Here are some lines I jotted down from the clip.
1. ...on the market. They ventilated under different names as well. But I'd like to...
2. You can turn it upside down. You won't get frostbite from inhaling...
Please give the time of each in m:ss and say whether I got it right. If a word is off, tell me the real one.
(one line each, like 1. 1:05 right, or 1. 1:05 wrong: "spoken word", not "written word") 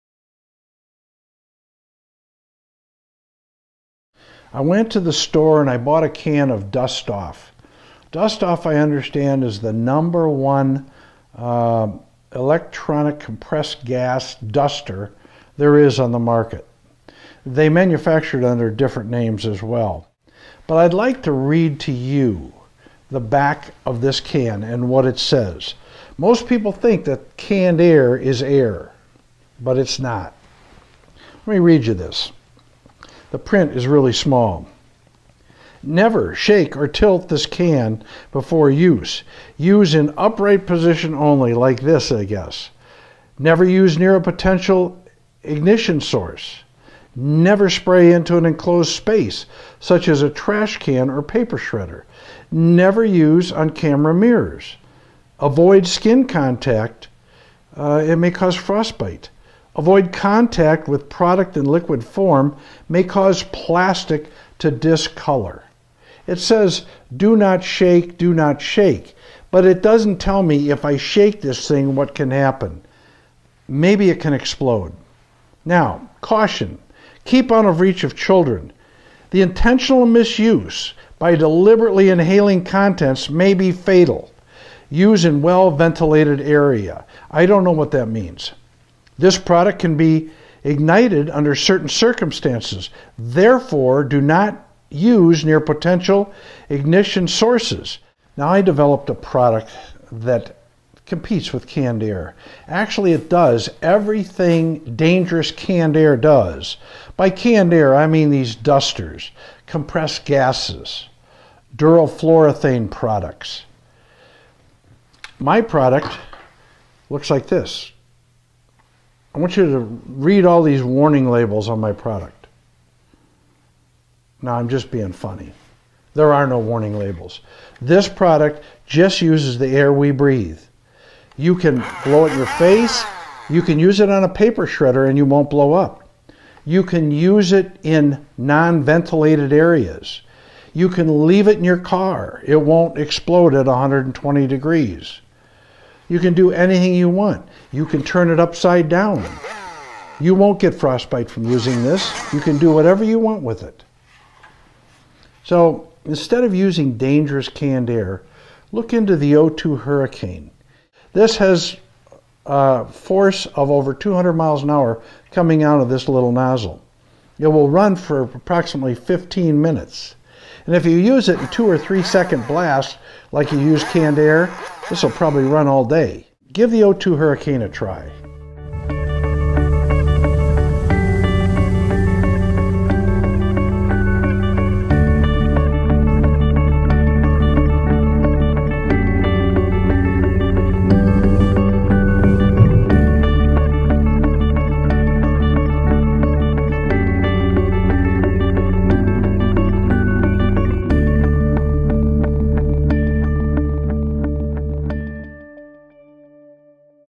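1. 0:15 wrong: "manufactured", not "ventilated"
2. 2:27 wrong: "using", not "inhaling".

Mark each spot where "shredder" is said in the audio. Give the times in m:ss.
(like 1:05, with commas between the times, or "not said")
0:51, 2:14.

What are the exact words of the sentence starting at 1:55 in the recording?
My product looks like this I want you to read all these warning labels on my product.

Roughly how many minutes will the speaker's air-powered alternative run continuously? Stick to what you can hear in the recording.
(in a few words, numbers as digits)
15 minutes.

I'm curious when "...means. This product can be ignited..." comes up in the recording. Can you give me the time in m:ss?
1:28.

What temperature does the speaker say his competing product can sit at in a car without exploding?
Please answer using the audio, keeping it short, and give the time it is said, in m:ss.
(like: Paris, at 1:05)
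120 degrees, at 2:23.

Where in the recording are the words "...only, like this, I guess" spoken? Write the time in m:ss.
0:41.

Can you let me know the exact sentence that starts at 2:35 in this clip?
So instead of using dangerous canned air, look into the O2 Hurricane.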